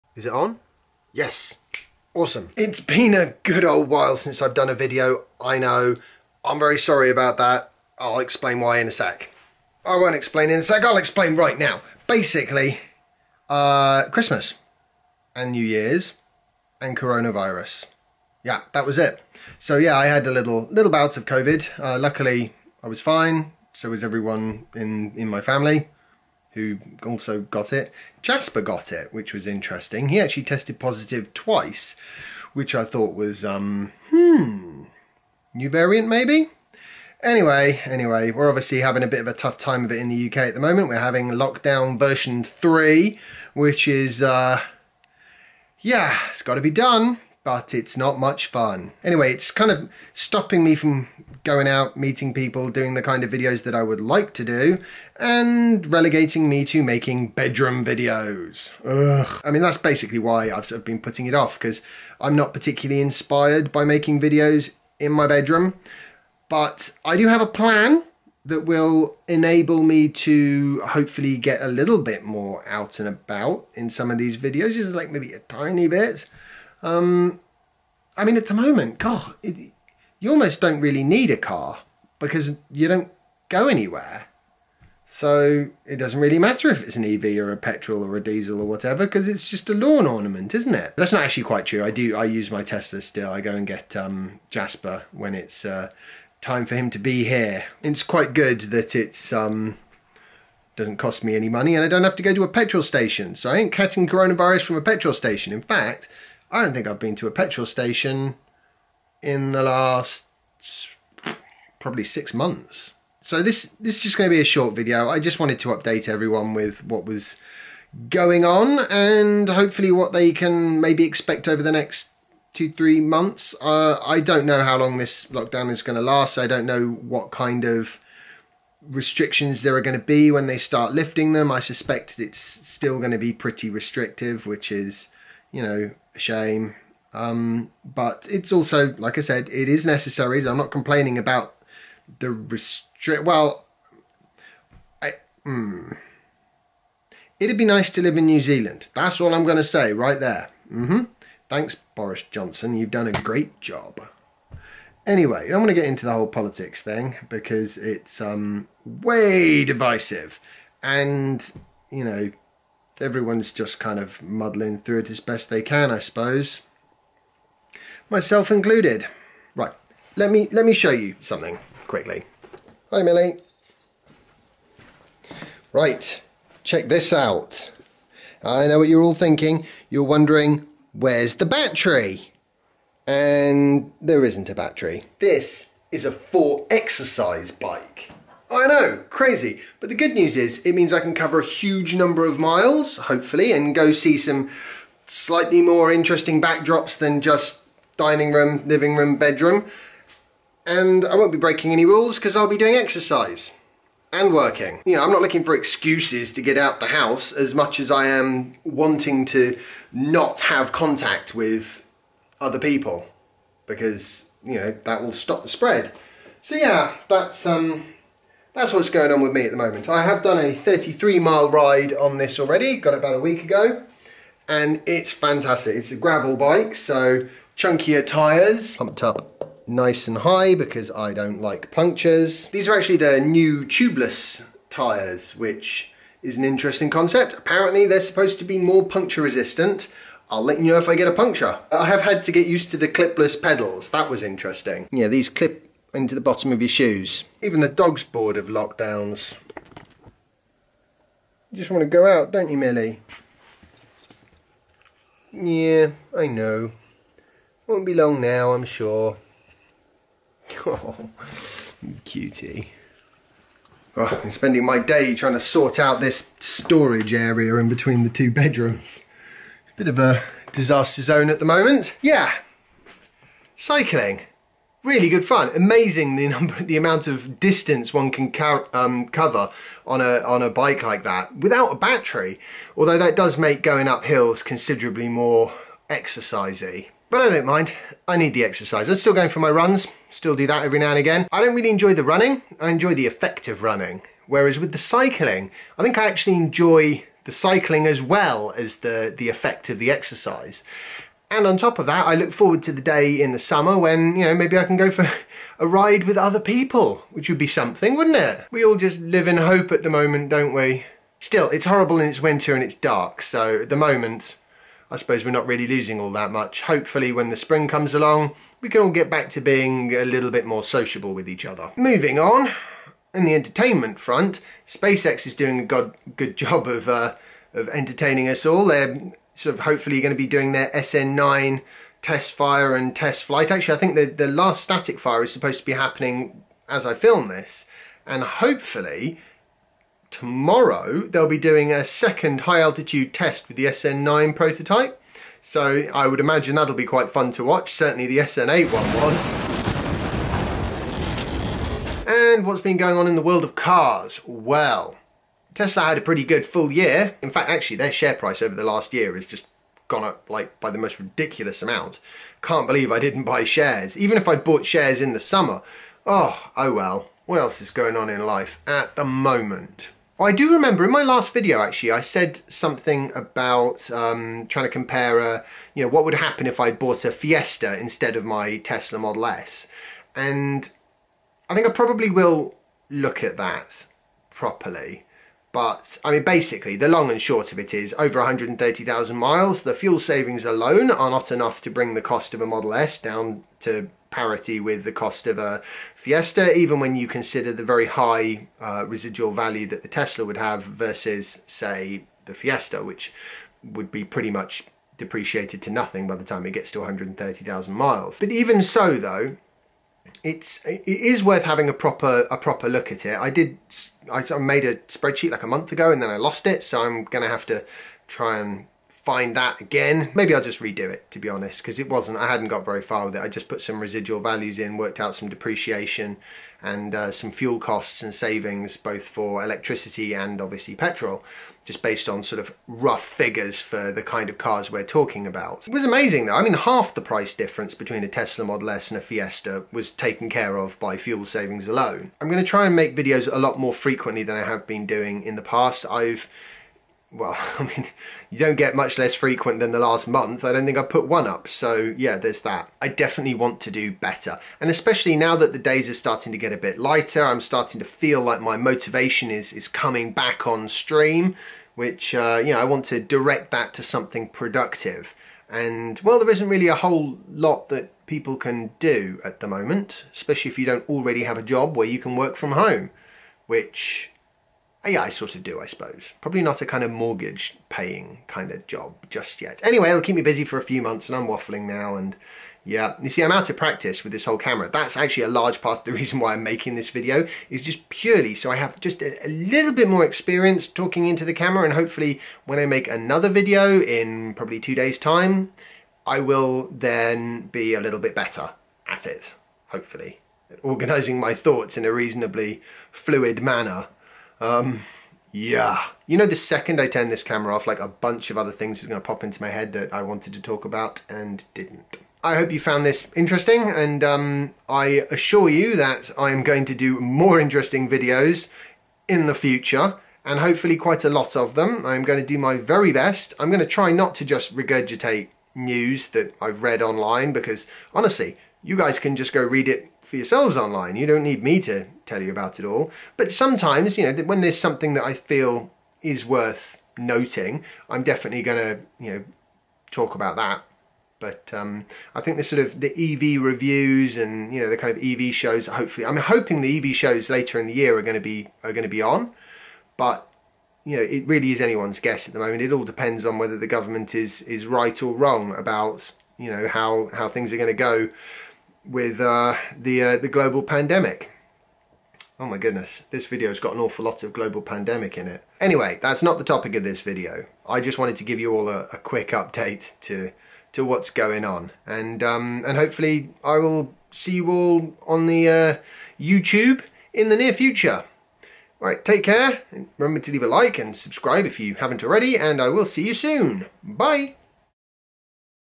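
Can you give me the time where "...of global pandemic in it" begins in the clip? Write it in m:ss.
9:24.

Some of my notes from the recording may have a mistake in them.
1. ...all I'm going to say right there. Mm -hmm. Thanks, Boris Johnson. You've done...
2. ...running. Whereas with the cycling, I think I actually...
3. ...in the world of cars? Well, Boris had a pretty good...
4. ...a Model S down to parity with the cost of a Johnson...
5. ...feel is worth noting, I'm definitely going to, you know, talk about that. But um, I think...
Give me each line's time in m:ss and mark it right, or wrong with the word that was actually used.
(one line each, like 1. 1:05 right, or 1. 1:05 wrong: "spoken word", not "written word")
1. 2:29 right
2. 4:53 right
3. 5:53 wrong: "Tesla", not "Boris"
4. 6:32 wrong: "Fiesta", not "Johnson"
5. 8:55 right.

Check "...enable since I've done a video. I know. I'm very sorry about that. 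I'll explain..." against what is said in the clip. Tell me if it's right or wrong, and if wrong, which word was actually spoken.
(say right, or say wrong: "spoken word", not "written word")
wrong: "while", not "enable".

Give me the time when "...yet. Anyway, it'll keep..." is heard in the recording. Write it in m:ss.
7:59.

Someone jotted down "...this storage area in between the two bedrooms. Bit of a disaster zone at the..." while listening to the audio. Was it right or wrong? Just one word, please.
right.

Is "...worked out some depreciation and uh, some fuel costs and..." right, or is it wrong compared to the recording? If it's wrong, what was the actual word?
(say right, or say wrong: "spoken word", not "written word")
right.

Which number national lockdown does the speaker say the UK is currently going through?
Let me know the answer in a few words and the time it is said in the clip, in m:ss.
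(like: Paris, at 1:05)
3, at 0:41.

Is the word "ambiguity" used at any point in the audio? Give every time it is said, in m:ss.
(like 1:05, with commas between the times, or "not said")
not said.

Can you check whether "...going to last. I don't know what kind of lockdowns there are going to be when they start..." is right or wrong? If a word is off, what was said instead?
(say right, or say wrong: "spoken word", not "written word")
wrong: "restrictions", not "lockdowns".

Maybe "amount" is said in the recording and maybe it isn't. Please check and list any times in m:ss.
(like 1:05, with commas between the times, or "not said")
4:36, 6:01.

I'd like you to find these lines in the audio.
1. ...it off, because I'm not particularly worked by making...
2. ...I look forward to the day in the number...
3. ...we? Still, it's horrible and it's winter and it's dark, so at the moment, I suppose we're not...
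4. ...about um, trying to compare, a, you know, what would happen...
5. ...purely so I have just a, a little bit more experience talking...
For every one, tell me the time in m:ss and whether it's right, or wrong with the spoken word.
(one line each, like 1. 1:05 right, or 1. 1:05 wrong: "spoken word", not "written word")
1. 1:01 wrong: "inspired", not "worked"
2. 5:02 wrong: "summer", not "number"
3. 5:10 right
4. 6:13 right
5. 8:07 right.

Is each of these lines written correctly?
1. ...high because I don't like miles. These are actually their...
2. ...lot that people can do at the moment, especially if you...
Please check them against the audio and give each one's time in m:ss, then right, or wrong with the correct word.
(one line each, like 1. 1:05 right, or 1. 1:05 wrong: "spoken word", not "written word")
1. 3:50 wrong: "punctures", not "miles"
2. 7:47 right.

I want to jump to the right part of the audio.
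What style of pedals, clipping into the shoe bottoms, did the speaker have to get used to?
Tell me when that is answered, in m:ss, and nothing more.
4:02.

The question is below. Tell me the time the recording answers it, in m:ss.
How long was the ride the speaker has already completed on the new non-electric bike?
3:40.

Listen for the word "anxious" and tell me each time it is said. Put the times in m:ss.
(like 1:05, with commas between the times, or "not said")
not said.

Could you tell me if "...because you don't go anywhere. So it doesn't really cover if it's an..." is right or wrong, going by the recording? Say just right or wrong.
wrong.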